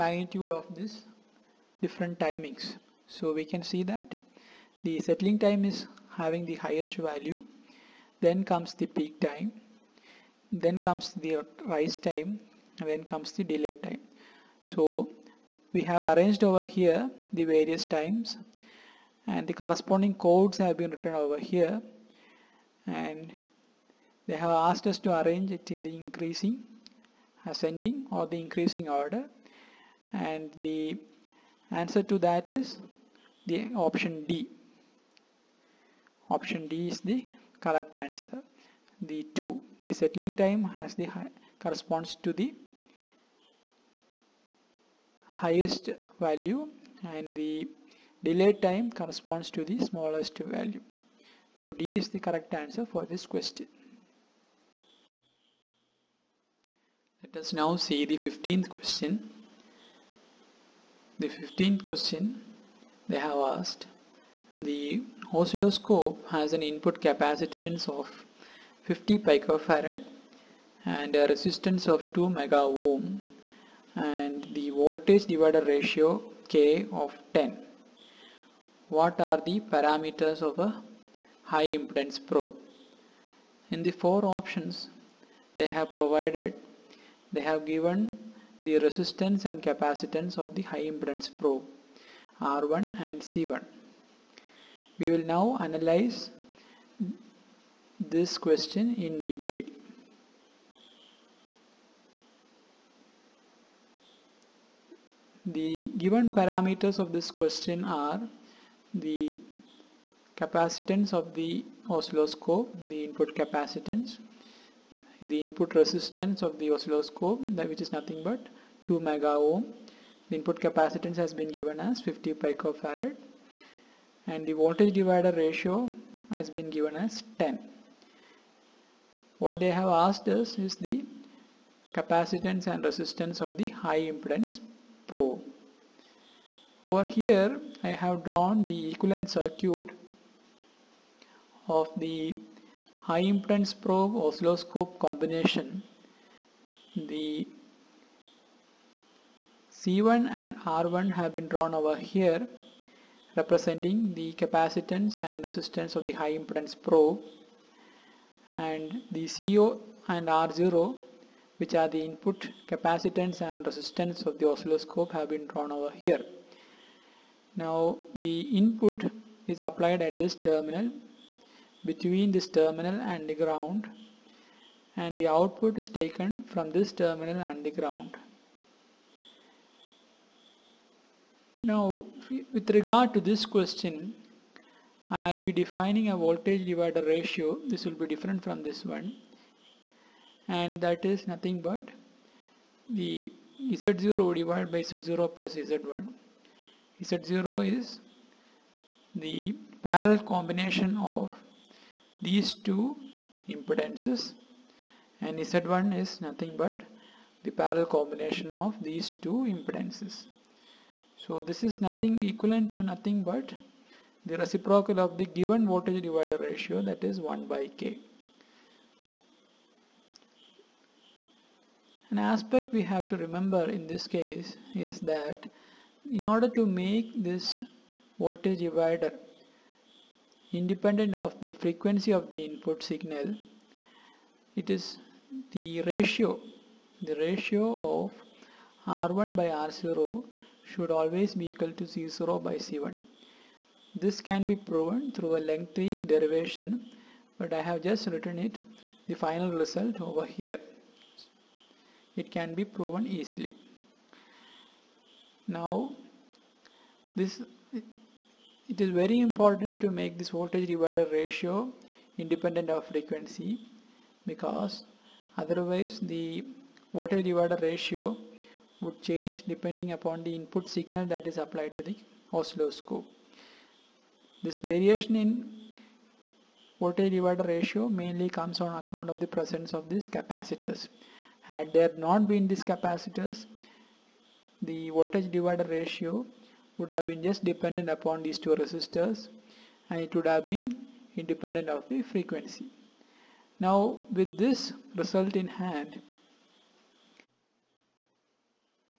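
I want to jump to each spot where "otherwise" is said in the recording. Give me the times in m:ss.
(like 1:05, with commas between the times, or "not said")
4:25.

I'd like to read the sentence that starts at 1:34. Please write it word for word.
We will now analyze this question in detail.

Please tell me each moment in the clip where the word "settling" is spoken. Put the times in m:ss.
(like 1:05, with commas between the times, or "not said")
0:05, 0:39.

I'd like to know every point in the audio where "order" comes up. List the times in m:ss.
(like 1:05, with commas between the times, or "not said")
0:28, 3:46.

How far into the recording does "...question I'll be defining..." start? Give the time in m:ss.
3:03.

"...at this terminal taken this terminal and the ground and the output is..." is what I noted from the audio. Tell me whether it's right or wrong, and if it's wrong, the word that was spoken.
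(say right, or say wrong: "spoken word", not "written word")
wrong: "between", not "taken".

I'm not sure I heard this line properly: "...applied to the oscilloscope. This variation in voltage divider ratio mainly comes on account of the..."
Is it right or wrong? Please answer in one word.
right.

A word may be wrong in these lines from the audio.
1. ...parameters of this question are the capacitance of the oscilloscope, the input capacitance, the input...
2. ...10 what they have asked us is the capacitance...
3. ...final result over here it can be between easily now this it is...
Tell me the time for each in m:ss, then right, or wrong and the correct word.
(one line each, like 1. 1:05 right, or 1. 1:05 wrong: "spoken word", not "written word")
1. 1:46 right
2. 2:07 right
3. 4:09 wrong: "proven", not "between".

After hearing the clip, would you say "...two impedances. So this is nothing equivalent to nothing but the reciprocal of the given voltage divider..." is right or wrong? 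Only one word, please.
right.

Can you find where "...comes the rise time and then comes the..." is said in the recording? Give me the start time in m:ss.
0:10.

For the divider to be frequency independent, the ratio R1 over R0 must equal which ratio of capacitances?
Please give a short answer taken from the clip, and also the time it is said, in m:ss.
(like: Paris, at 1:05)
C0 by C1, at 4:01.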